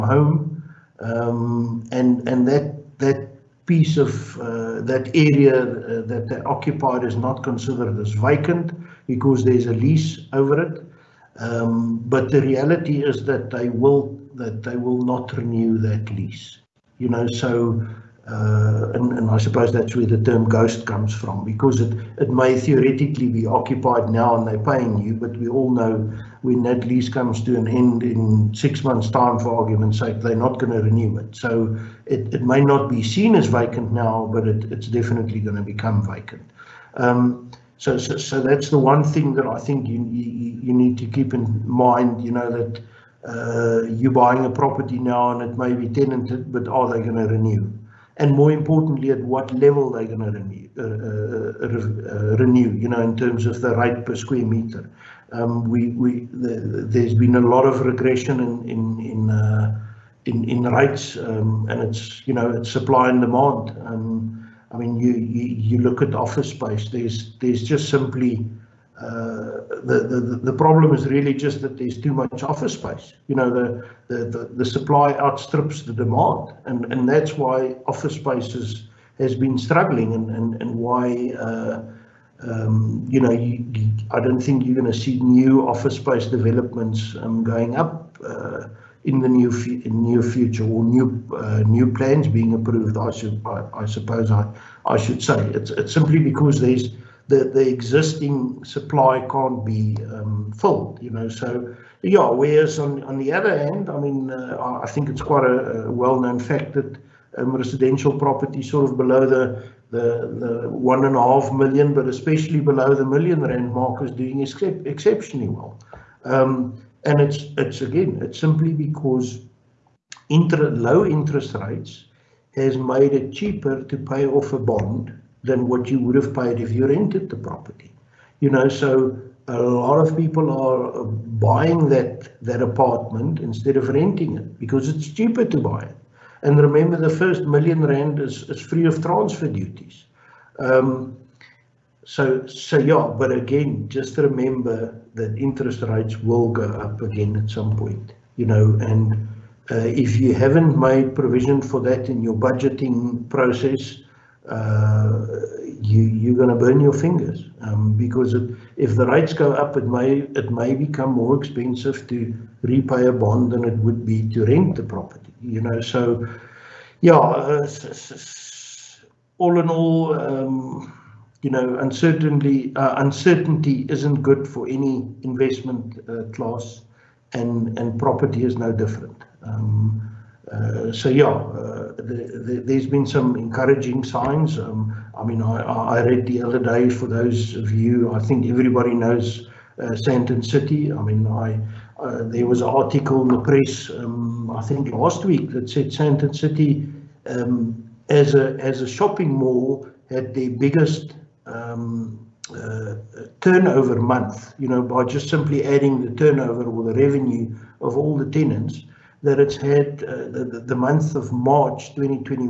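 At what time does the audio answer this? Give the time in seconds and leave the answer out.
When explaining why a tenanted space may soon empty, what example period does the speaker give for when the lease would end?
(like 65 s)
28 s.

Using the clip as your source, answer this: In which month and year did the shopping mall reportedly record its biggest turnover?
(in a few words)
March 2021.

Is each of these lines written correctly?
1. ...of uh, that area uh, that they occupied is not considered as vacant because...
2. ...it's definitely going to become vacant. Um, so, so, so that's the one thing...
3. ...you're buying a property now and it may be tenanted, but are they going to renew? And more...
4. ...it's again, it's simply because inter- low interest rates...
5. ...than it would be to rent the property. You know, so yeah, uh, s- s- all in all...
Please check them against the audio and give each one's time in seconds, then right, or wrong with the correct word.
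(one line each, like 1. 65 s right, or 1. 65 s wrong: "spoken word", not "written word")
1. 3 s right
2. 34 s right
3. 43 s right
4. 117 s right
5. 163 s right.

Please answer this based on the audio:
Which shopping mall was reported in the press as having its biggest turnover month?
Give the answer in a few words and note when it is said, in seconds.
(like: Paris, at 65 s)
Sandton City, at 195 s.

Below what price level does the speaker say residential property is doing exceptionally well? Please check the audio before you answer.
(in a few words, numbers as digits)
1 million rand.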